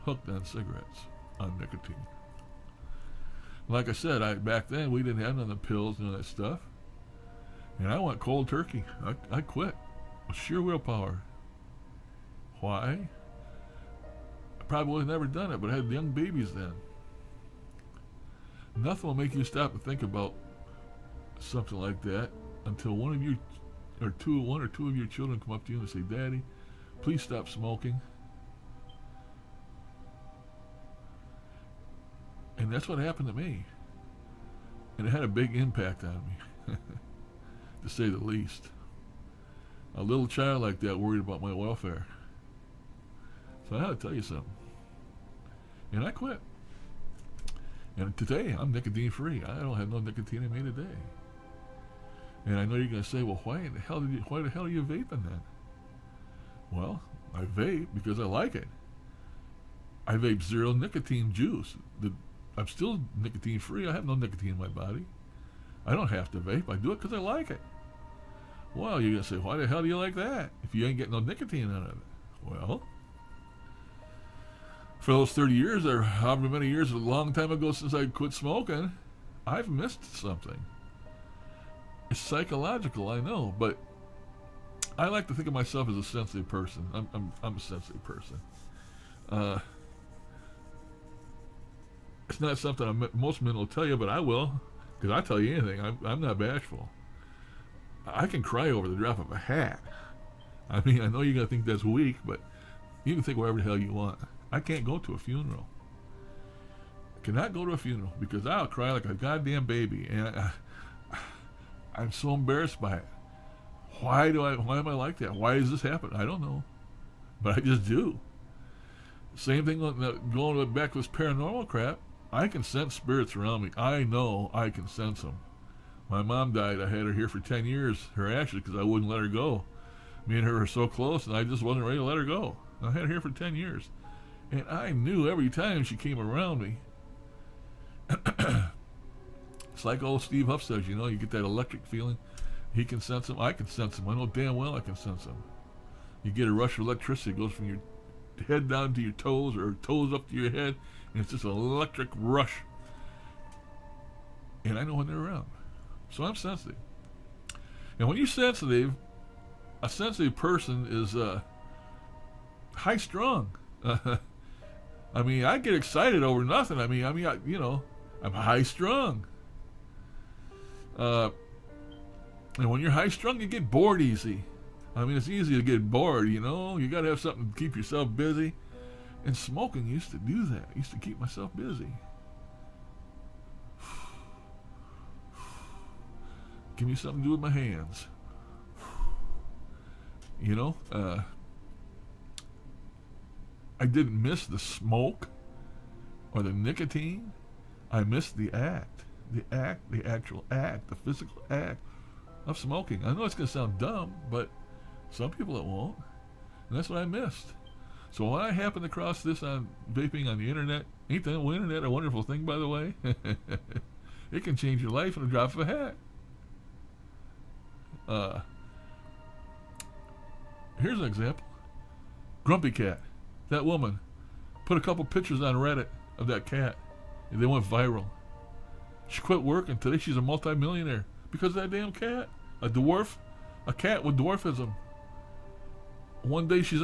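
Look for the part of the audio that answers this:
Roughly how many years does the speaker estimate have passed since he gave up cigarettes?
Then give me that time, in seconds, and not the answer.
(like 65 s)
75 s.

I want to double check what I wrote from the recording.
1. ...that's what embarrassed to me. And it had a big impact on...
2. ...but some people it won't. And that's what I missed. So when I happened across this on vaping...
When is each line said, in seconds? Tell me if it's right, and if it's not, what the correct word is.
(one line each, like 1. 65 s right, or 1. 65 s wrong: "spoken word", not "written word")
1. 32 s wrong: "happened", not "embarrassed"
2. 204 s right.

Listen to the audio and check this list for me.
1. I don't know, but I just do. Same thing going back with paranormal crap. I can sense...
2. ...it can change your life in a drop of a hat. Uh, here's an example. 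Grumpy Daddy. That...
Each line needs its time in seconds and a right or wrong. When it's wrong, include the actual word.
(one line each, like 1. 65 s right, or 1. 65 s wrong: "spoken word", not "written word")
1. 116 s right
2. 214 s wrong: "Cat", not "Daddy".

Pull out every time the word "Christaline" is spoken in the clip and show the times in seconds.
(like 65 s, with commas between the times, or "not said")
not said.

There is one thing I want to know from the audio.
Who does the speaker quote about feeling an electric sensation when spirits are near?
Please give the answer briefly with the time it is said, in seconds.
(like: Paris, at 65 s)
Steve Huff, at 140 s.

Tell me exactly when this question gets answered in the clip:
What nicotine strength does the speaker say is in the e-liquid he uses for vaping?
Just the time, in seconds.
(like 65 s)
60 s.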